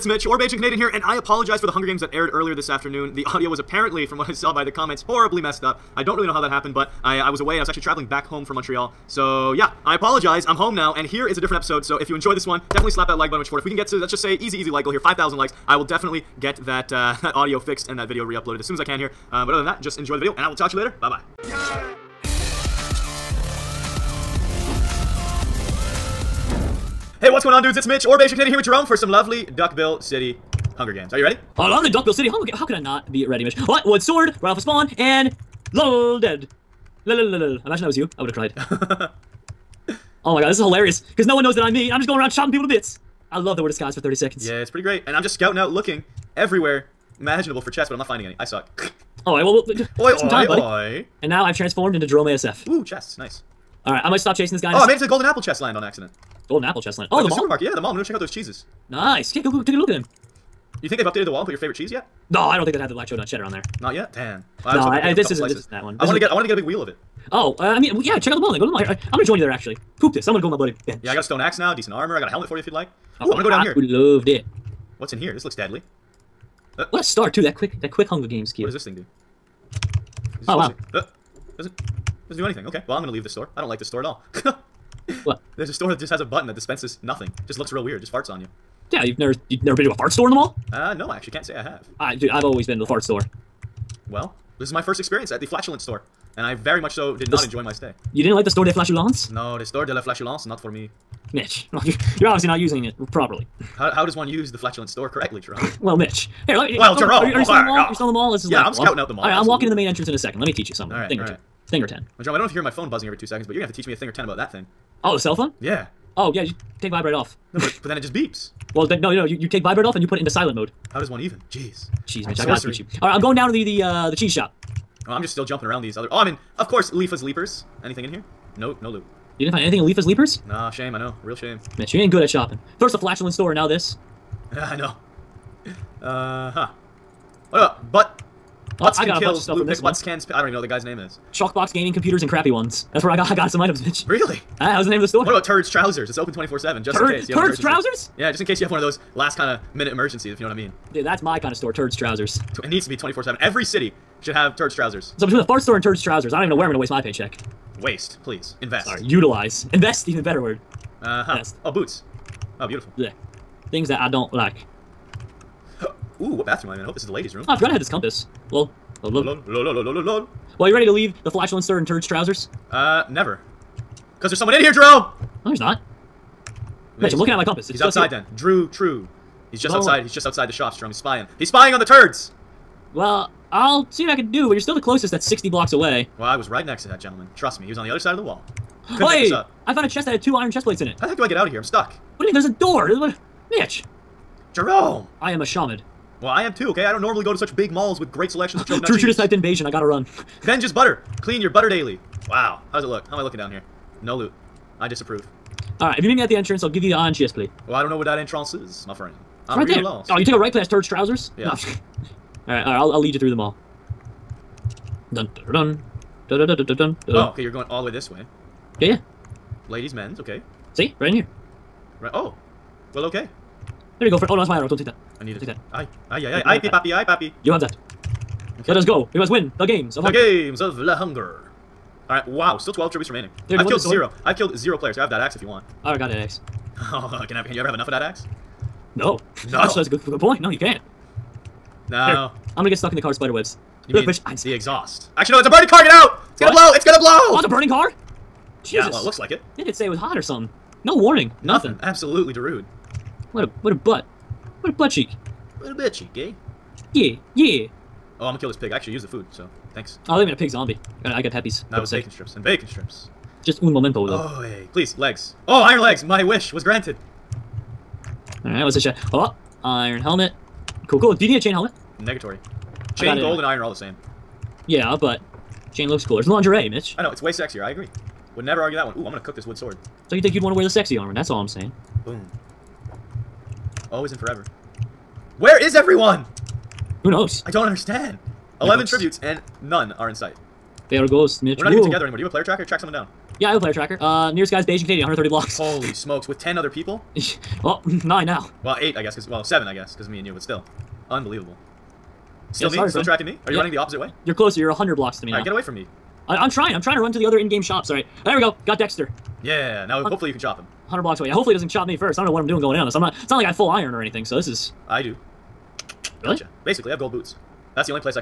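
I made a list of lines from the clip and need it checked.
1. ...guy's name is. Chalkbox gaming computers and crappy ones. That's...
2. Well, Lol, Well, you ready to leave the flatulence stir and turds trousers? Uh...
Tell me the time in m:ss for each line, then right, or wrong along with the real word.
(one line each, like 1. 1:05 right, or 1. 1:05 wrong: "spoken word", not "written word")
1. 2:20 right
2. 2:48 right.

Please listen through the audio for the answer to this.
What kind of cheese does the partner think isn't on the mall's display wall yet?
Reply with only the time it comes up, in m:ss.
1:02.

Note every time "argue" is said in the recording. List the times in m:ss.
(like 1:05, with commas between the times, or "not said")
4:38.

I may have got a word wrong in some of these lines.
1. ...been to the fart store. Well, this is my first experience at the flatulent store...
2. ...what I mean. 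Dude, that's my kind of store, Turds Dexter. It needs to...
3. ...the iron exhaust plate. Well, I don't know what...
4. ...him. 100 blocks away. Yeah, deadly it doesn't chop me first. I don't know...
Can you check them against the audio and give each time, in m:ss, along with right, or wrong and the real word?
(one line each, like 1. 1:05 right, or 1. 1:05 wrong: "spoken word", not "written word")
1. 1:32 right
2. 2:30 wrong: "Trousers", not "Dexter"
3. 3:26 wrong: "chest", not "exhaust"
4. 5:10 wrong: "hopefully", not "deadly".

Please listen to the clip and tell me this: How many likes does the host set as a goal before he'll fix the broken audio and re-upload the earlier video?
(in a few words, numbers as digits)
5,000.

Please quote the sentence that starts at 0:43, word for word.
I love that we're disguised for 30 seconds.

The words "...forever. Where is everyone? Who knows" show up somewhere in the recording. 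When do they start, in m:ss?
4:44.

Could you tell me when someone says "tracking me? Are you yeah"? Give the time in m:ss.
5:03.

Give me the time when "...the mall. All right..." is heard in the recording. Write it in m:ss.
1:49.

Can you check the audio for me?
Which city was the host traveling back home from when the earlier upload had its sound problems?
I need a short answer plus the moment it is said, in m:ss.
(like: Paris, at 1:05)
Montreal, at 0:08.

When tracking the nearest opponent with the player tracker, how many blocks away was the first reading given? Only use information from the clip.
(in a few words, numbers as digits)
130.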